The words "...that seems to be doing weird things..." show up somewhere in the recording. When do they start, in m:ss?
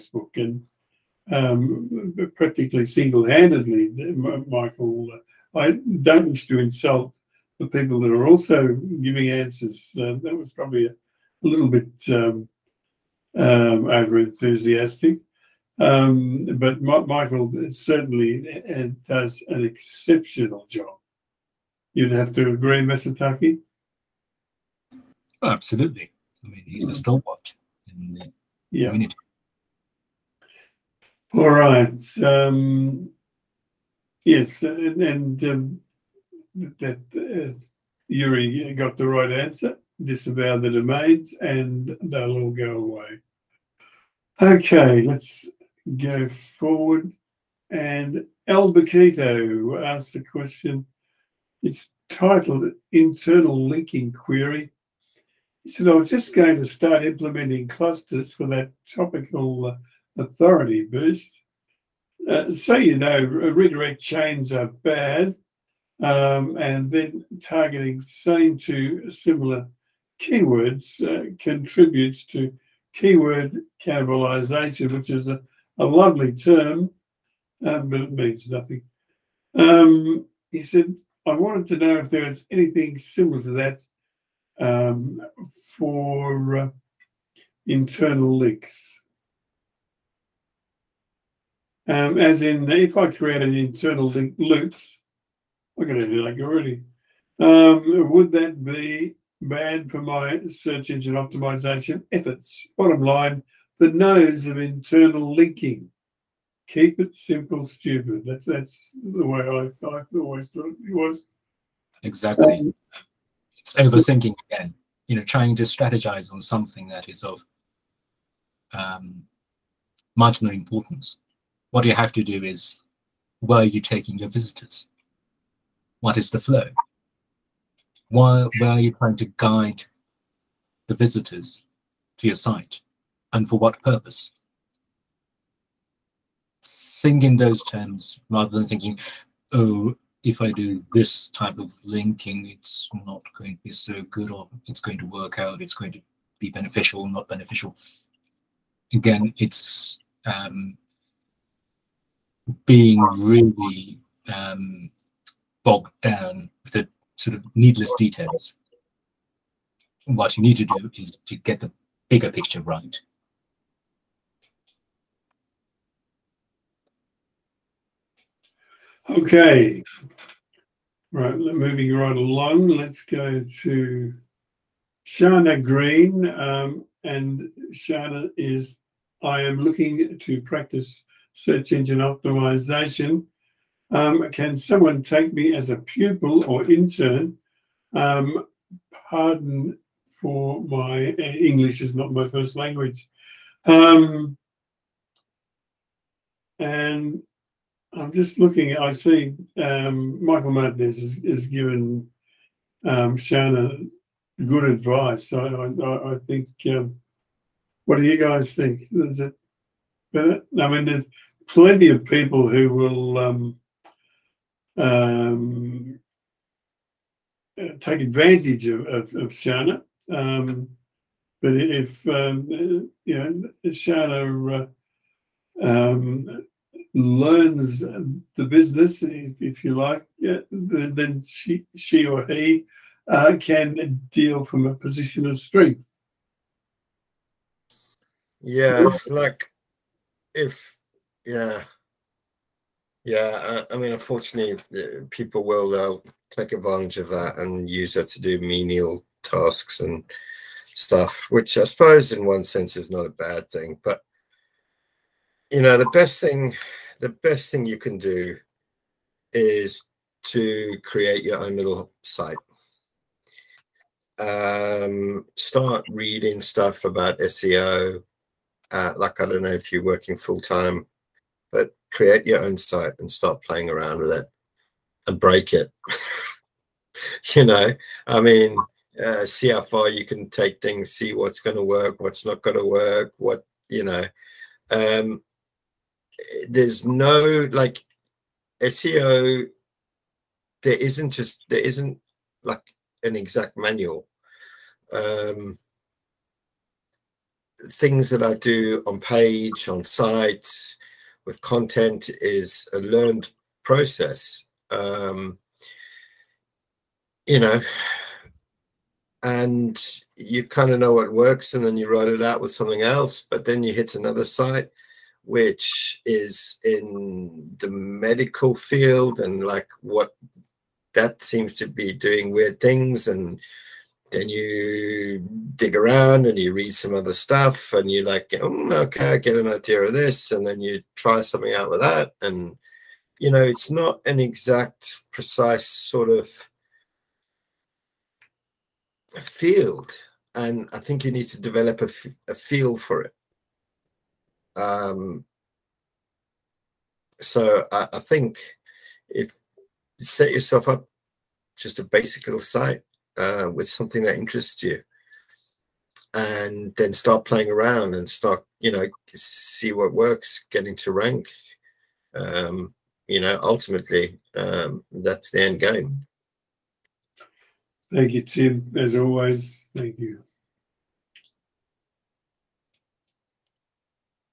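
5:20.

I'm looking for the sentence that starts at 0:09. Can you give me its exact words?
that was probably a, a little bit um, um over enthusiastic.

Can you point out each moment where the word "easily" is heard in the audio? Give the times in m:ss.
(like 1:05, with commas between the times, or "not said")
not said.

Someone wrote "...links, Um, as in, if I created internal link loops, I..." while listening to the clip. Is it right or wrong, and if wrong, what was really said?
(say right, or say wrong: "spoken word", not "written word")
right.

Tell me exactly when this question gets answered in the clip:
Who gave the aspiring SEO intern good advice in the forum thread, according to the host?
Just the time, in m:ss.
3:20.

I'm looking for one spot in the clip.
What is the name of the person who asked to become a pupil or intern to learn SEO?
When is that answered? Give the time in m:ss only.
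2:55.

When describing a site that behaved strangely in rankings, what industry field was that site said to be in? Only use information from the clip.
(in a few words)
medical.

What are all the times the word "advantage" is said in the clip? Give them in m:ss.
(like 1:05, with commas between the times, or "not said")
3:38, 4:06.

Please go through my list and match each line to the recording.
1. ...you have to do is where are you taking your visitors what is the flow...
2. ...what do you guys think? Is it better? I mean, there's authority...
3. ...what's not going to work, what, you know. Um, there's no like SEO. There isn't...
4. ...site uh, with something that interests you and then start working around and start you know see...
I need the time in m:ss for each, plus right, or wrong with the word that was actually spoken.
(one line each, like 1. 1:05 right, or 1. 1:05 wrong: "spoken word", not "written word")
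1. 2:01 right
2. 3:27 wrong: "plenty", not "authority"
3. 4:42 right
4. 5:52 wrong: "playing", not "working".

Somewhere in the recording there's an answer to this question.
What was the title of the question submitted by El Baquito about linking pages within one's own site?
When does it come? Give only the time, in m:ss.
0:52.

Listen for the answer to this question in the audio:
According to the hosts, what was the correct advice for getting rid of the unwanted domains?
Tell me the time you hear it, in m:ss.
0:40.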